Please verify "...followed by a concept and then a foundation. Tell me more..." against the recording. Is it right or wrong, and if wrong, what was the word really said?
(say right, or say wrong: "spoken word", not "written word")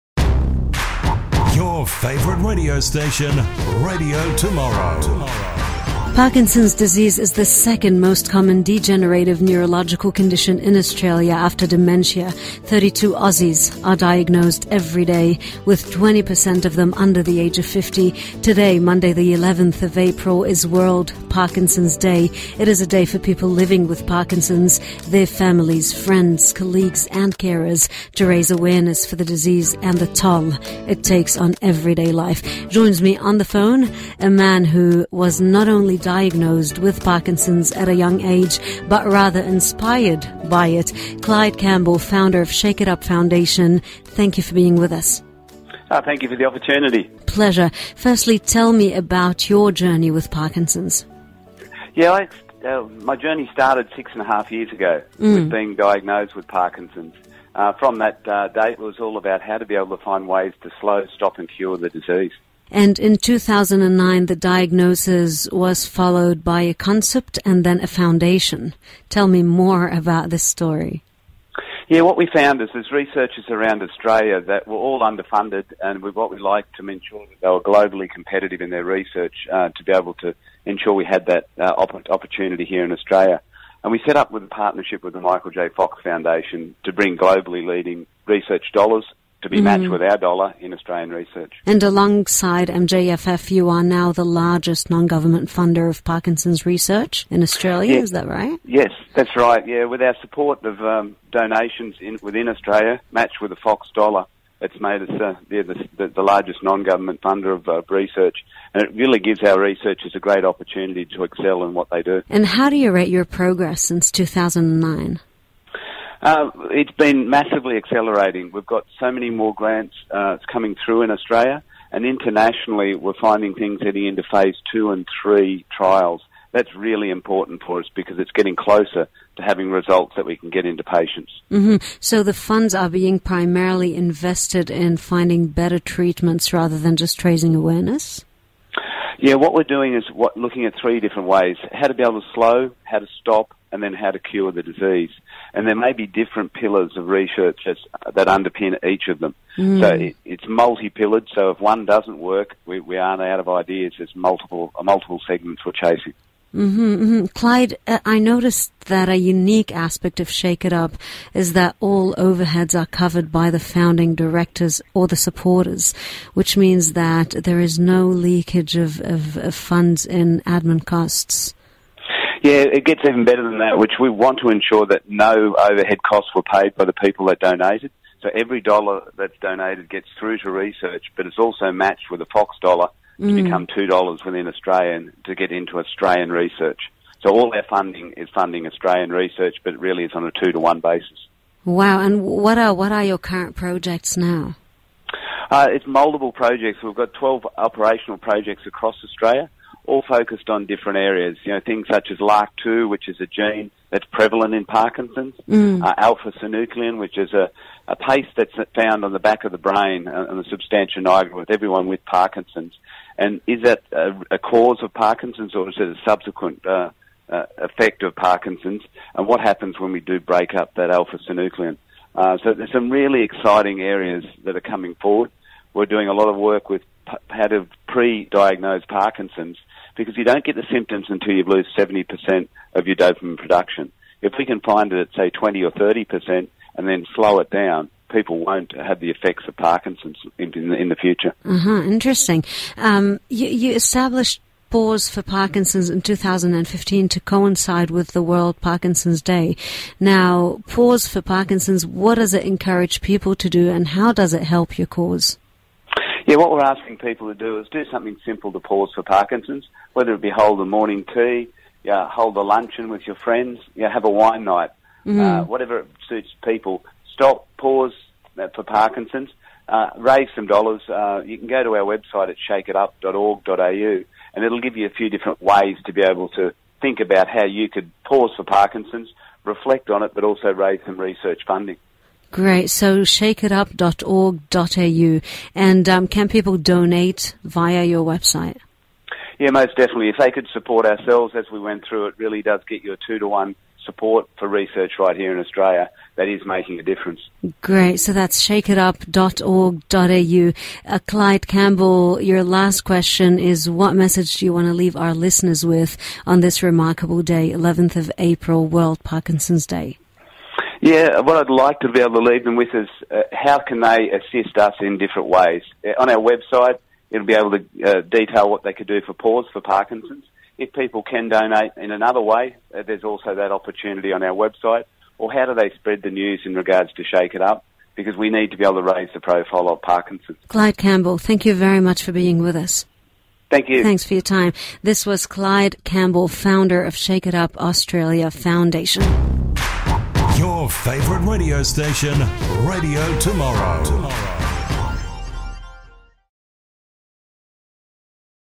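right.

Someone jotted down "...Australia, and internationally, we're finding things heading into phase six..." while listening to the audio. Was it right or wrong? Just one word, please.
wrong.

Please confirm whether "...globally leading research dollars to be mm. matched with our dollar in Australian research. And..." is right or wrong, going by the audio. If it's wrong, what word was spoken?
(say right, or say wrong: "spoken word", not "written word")
right.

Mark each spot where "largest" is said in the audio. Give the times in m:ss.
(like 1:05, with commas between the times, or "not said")
1:34, 1:46.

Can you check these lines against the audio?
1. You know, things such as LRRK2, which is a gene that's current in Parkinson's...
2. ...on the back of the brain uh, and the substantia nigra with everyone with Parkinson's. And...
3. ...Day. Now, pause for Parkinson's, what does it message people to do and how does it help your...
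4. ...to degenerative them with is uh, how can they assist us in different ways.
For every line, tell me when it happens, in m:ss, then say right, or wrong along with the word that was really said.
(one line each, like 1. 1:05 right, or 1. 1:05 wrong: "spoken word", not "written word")
1. 3:21 wrong: "prevalent", not "current"
2. 3:29 right
3. 4:09 wrong: "encourage", not "message"
4. 5:12 wrong: "leave", not "degenerative".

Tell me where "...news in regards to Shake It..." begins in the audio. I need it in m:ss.
5:26.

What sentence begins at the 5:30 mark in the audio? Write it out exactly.
Clyde Campbell, thank you very much for being with us.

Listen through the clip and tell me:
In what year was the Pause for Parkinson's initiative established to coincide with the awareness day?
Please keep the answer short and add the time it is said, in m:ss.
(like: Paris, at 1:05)
2015, at 4:06.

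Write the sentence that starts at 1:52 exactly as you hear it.
And how do you rate your progress since 2009?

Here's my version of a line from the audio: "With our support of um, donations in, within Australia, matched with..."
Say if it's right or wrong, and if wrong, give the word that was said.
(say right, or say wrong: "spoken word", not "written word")
right.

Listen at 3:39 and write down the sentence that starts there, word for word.
And what happens when we do break up that alpha synuclein?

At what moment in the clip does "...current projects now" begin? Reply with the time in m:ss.
3:13.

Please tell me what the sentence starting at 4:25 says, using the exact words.
uh, whatever suits people stop, pause uh, for Parkinson's.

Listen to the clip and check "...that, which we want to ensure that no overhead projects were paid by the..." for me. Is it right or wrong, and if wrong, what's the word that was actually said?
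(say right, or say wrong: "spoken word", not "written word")
wrong: "costs", not "projects".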